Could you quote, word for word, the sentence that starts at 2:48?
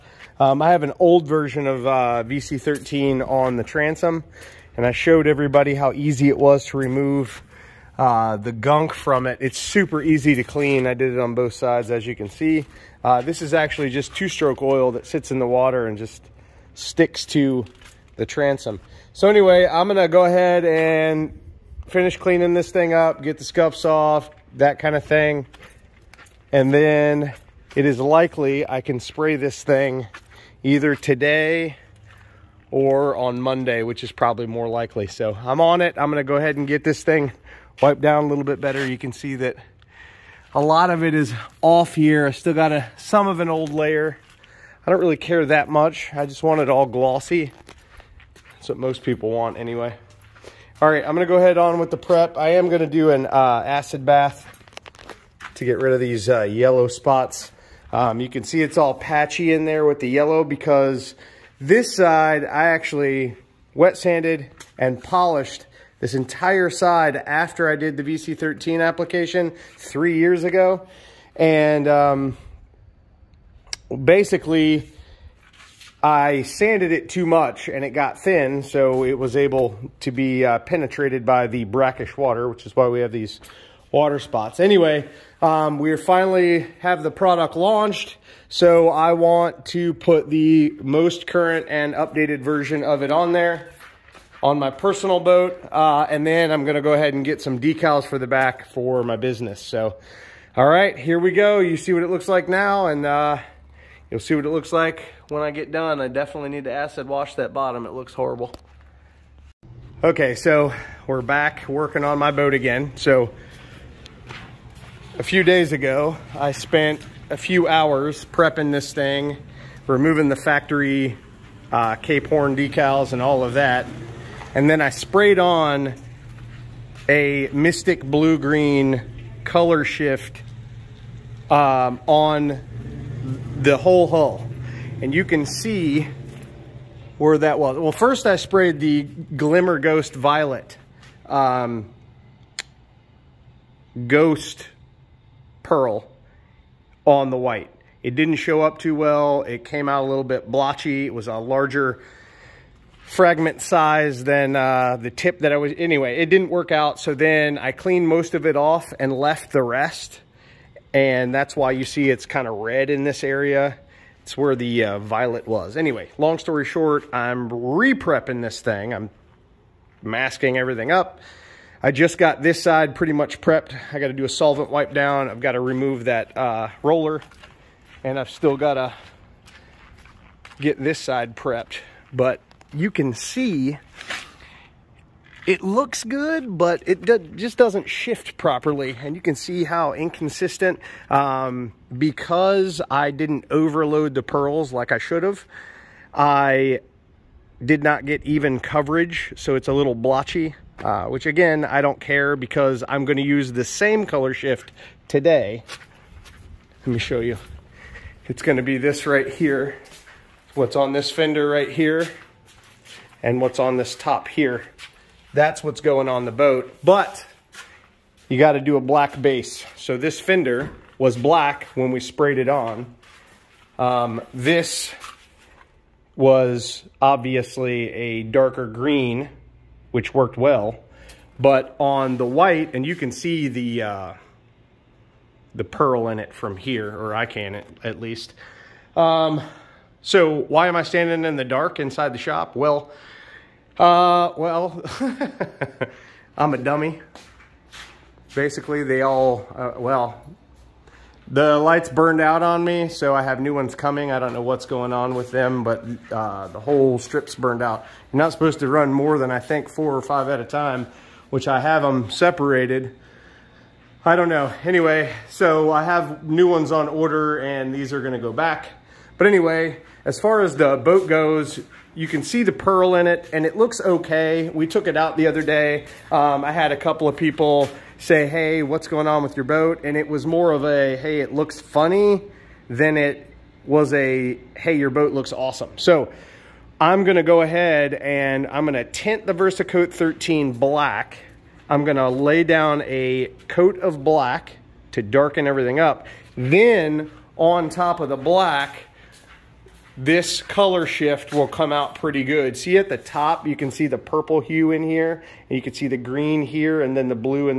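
I'm masking everything up I just got this side pretty much prepped.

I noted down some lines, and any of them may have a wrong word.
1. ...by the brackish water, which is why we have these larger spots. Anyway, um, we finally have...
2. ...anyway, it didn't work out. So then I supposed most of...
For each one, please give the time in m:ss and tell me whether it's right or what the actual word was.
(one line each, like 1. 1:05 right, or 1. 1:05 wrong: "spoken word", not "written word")
1. 1:21 wrong: "water", not "larger"
2. 2:35 wrong: "cleaned", not "supposed".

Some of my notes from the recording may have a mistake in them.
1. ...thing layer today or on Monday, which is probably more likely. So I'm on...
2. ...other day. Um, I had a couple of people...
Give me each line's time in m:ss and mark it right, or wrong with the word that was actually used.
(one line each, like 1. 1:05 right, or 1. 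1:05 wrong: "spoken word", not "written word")
1. 0:29 wrong: "either", not "layer"
2. 4:35 right.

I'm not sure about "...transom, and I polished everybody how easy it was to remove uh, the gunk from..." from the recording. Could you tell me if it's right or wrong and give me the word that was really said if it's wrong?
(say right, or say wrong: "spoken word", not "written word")
wrong: "showed", not "polished".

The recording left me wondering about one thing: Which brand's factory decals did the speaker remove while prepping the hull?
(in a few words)
Cape Horn.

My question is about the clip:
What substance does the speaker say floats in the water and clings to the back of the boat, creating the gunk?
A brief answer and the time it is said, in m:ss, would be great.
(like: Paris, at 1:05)
two-stroke oil, at 0:14.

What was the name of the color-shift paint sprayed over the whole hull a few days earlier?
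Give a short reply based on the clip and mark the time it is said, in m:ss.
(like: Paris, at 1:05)
Mystic Blue Green, at 2:07.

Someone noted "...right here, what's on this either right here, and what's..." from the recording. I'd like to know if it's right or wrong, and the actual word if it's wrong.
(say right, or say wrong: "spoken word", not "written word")
wrong: "fender", not "either".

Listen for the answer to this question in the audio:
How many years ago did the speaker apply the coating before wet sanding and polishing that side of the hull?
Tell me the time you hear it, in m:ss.
1:09.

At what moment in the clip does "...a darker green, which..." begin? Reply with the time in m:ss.
3:47.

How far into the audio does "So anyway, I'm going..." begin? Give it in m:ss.
0:19.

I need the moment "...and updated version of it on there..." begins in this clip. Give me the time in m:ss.
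1:31.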